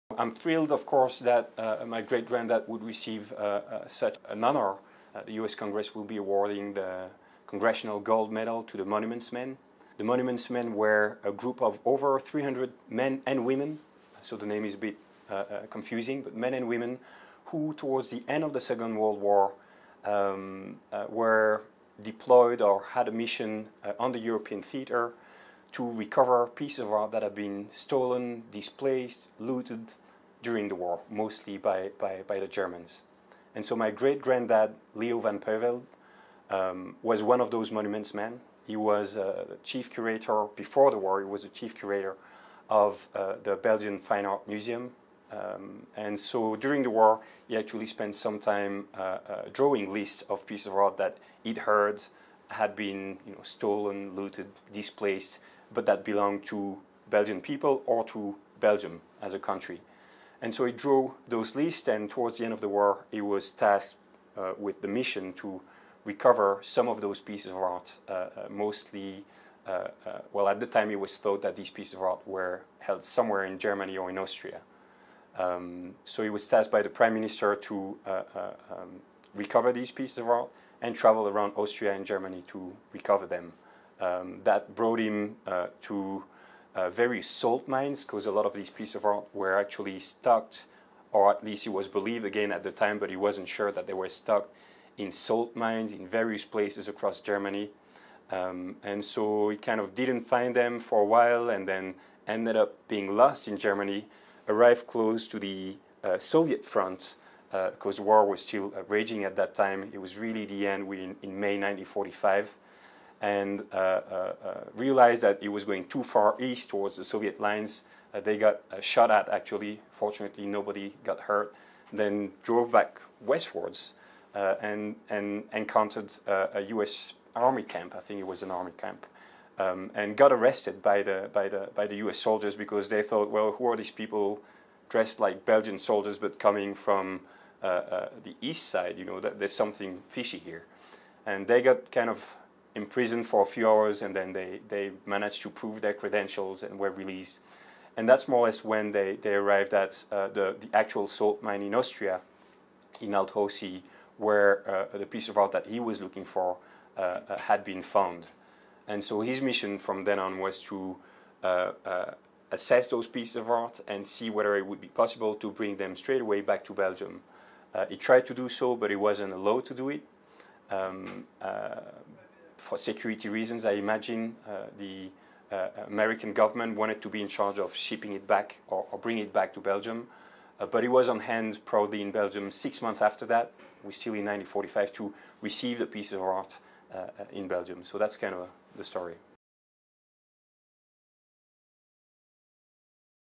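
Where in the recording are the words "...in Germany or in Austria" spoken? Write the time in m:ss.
1:13.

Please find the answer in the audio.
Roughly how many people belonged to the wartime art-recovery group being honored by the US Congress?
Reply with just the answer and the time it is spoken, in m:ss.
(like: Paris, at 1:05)
over 300, at 0:11.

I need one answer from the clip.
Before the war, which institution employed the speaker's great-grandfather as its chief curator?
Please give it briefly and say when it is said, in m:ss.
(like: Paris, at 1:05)
Belgian Fine Art Museum, at 0:43.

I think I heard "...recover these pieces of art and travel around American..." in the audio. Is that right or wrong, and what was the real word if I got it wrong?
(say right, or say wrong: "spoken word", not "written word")
wrong: "Austria", not "American".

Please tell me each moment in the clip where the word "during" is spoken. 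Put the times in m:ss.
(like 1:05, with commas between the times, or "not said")
0:30, 0:46.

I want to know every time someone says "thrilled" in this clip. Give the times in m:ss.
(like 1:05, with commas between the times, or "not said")
0:00.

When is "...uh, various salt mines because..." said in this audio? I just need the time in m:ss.
1:26.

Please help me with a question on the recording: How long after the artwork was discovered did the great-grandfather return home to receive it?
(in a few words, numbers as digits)
6 months.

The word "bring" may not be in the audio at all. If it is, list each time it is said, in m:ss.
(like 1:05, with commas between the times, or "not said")
2:45, 2:58.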